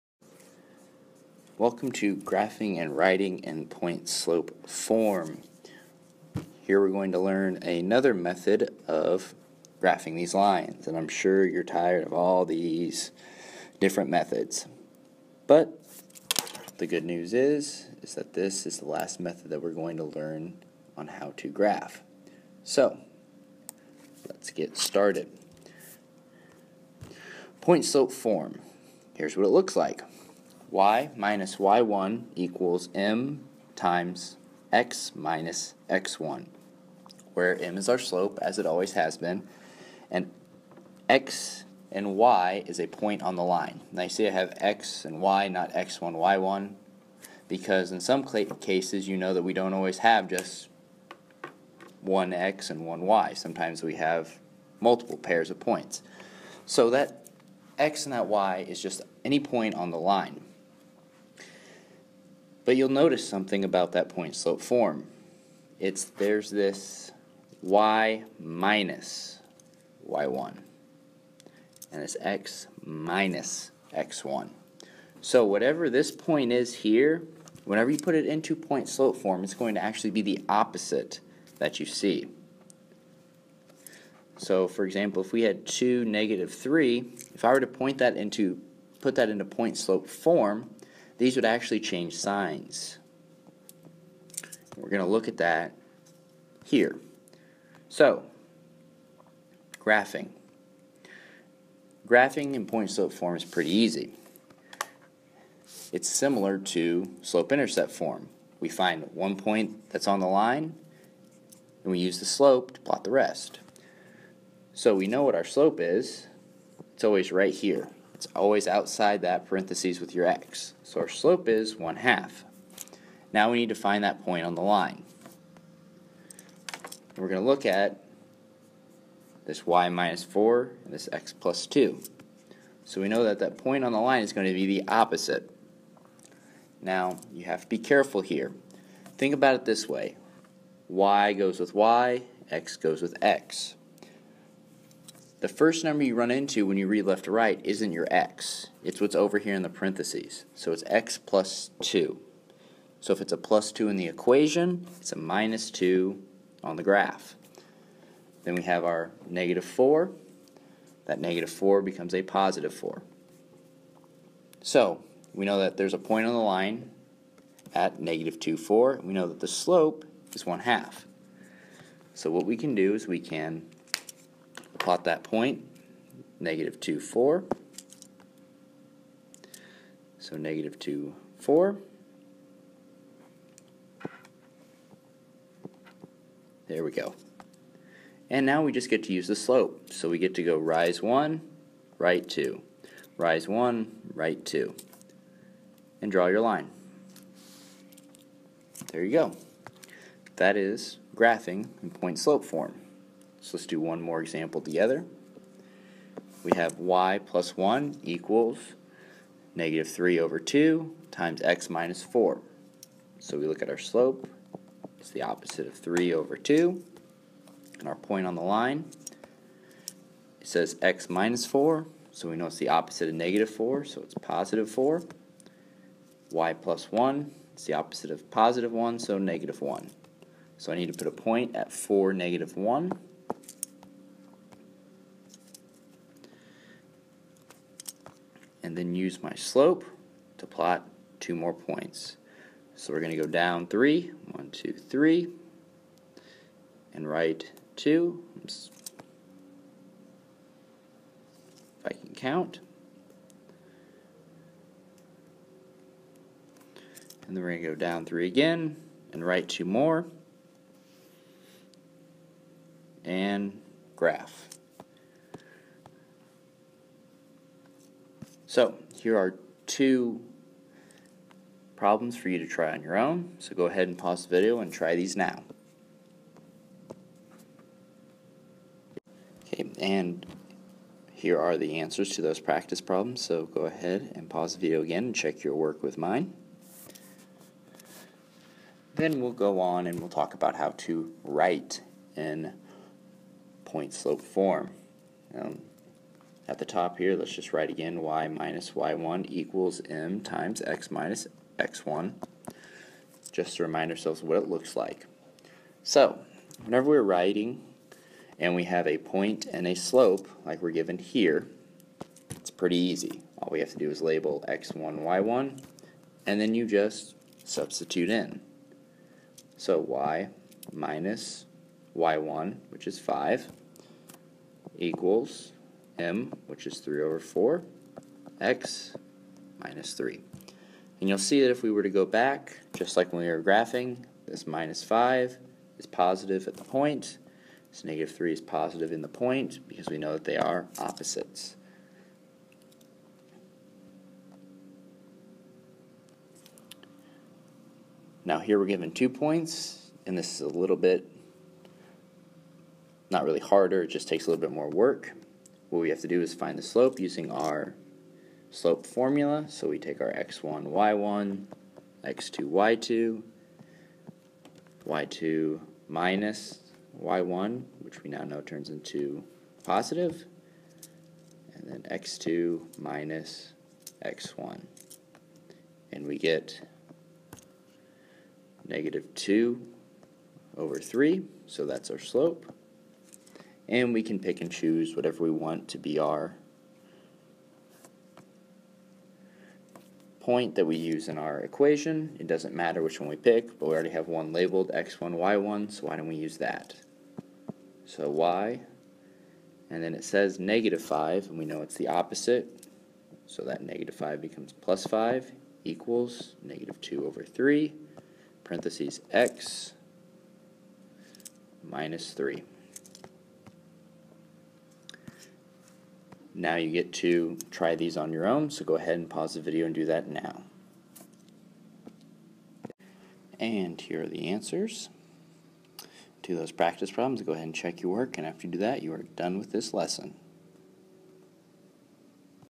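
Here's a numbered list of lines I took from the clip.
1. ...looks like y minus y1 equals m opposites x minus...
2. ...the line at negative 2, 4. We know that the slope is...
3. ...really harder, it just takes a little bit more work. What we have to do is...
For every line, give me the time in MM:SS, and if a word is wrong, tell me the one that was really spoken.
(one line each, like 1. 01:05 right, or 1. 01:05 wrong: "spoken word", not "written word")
1. 00:29 wrong: "times", not "opposites"
2. 02:46 right
3. 05:53 right.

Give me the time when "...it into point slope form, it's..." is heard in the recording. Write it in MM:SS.
01:18.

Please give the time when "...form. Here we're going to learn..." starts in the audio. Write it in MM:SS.
00:04.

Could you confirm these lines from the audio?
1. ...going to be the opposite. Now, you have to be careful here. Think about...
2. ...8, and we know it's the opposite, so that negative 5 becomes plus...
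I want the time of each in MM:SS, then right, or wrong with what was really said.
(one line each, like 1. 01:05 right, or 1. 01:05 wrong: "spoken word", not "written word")
1. 02:14 right
2. 06:40 wrong: "5", not "8".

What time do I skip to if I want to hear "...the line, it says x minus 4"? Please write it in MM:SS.
03:38.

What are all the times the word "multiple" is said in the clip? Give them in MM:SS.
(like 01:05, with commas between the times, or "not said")
00:54.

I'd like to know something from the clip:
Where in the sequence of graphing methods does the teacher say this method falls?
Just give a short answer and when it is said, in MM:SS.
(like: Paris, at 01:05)
the last, at 00:18.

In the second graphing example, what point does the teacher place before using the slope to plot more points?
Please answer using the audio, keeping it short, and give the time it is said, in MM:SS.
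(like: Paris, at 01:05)
(4, -1), at 03:51.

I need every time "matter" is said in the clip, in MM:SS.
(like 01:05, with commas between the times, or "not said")
06:32.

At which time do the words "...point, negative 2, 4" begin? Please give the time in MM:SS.
02:55.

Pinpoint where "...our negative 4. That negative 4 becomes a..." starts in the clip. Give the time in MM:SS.
02:38.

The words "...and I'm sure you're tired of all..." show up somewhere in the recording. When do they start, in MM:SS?
00:10.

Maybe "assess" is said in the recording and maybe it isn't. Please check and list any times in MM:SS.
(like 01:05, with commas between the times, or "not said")
not said.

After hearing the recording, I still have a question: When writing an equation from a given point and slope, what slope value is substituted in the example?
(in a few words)
3/4.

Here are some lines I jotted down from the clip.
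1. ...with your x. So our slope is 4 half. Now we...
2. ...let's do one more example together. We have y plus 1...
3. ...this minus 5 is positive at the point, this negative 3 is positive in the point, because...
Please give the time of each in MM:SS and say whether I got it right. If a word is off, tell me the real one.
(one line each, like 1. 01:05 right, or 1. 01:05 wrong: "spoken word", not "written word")
1. 01:59 wrong: "1", not "4"
2. 03:23 right
3. 05:34 right.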